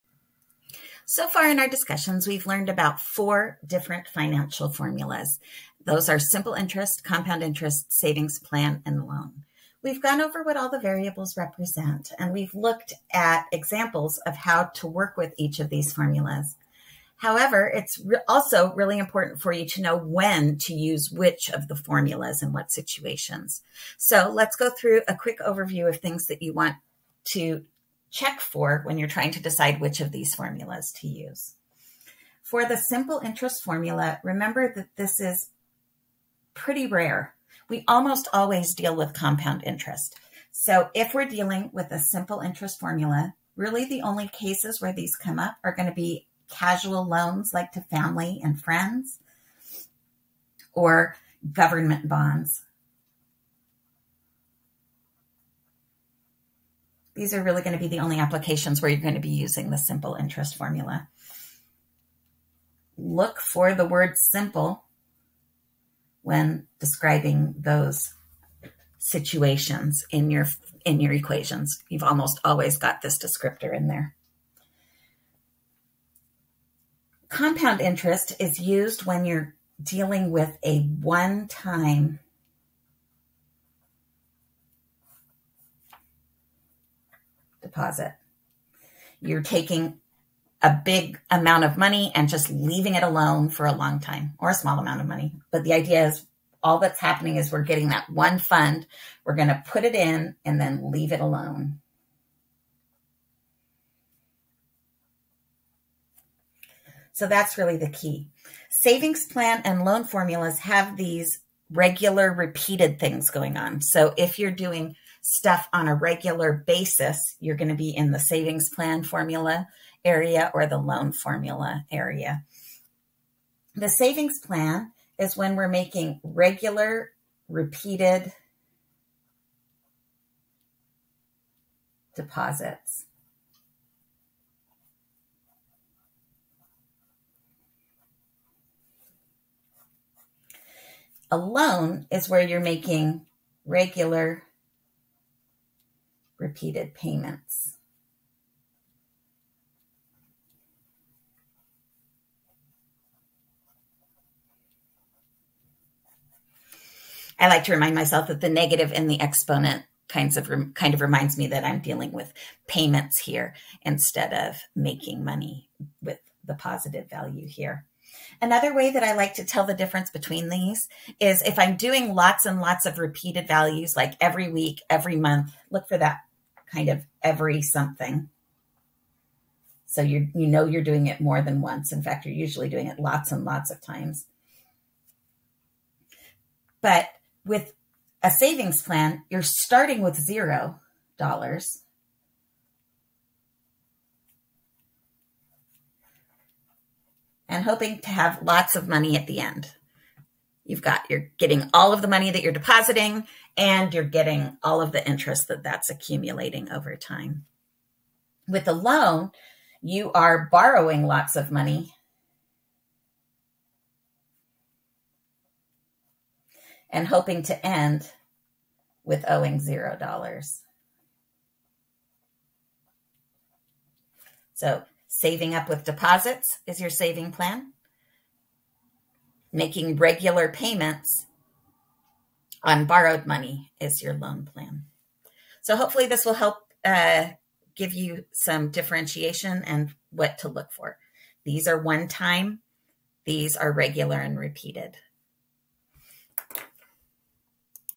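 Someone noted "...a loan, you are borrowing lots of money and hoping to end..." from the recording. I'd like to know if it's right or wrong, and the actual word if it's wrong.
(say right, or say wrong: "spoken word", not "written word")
right.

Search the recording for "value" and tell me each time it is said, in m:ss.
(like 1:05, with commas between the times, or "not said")
2:47, 2:53.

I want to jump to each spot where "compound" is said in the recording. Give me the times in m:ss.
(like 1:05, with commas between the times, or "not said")
0:07, 0:39, 1:17.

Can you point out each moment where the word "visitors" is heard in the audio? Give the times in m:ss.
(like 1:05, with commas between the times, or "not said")
not said.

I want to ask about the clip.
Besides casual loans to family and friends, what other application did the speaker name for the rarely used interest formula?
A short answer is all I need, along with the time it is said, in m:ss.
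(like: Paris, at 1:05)
government bonds, at 0:51.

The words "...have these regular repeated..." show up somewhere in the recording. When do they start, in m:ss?
1:50.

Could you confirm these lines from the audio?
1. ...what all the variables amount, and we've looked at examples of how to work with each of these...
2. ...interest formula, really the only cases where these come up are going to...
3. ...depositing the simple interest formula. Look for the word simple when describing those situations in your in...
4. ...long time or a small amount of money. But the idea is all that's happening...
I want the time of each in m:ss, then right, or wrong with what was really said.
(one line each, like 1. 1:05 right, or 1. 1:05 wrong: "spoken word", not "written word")
1. 0:10 wrong: "represent", not "amount"
2. 0:42 right
3. 0:59 wrong: "using", not "depositing"
4. 1:33 right.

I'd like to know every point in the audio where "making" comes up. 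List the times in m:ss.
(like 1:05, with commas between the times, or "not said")
2:05, 2:22, 2:44, 3:49.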